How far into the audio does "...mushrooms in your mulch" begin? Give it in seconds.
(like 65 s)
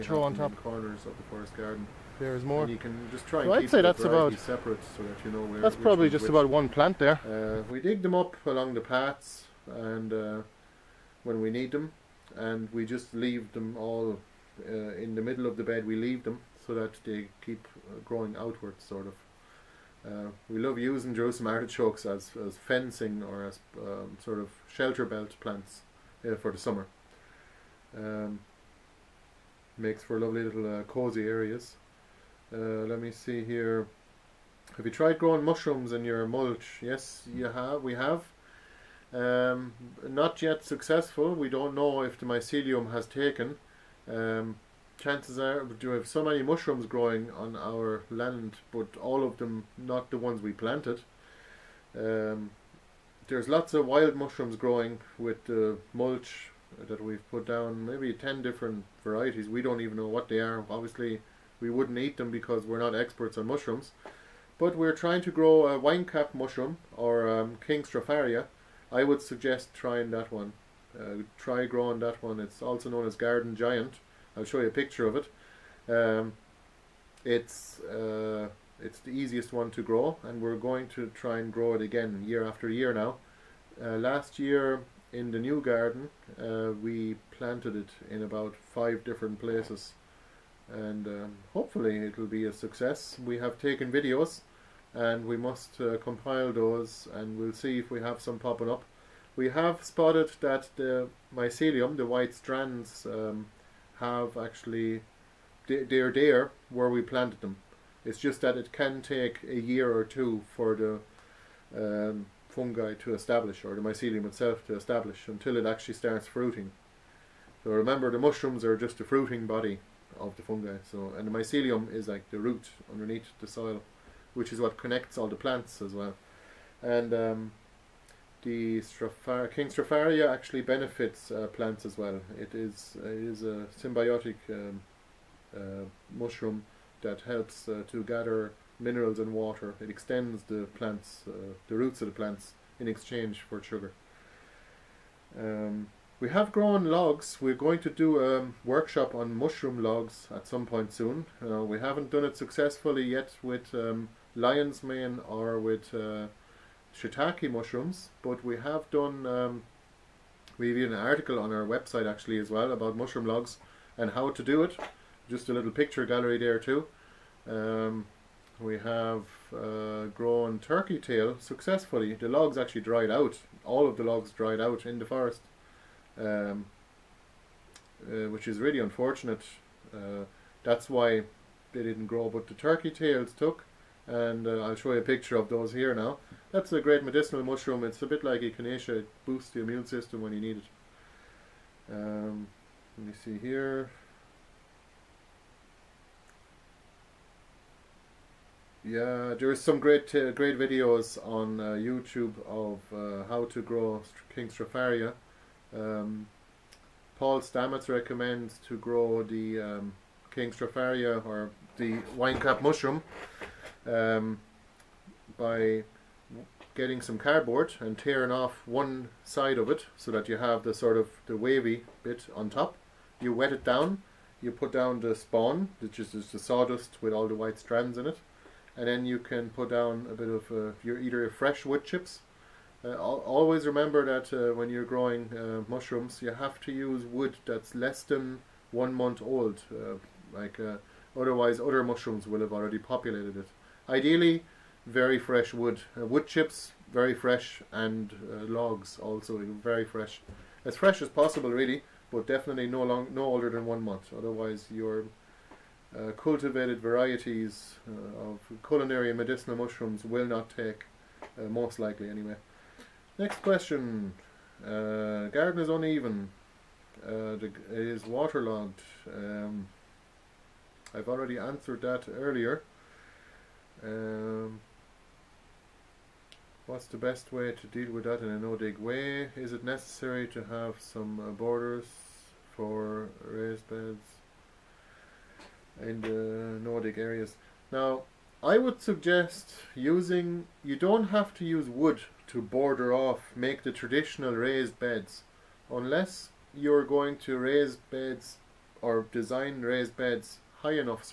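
35 s.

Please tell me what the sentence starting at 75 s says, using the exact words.
Um, it's uh, it's the easiest one to grow, and we're going to try and grow it again year after year now.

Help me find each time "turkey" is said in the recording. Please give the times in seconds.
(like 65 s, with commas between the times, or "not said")
170 s, 182 s.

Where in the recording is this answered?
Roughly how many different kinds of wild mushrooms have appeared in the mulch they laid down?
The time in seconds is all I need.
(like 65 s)
58 s.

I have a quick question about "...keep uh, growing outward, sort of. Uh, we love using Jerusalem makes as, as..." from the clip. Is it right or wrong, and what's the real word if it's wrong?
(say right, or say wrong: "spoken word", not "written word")
wrong: "artichokes", not "makes".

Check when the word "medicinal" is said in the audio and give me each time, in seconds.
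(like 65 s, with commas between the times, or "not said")
187 s, 259 s.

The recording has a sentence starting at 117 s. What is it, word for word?
So remember the mushrooms are just a fruiting body of the fungi.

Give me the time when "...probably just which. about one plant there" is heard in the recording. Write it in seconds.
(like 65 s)
5 s.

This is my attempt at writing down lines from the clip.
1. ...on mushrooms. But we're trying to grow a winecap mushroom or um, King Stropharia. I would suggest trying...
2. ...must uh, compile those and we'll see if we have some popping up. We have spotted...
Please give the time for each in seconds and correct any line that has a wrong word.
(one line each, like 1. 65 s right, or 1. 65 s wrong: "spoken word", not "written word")
1. 63 s right
2. 95 s right.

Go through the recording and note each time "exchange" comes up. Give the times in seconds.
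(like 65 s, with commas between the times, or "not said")
142 s.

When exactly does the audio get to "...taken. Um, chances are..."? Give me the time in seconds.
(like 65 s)
43 s.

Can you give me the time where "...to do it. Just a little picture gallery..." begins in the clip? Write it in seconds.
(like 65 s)
164 s.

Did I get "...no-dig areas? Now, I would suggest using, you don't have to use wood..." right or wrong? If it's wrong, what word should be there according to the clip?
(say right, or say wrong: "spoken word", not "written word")
right.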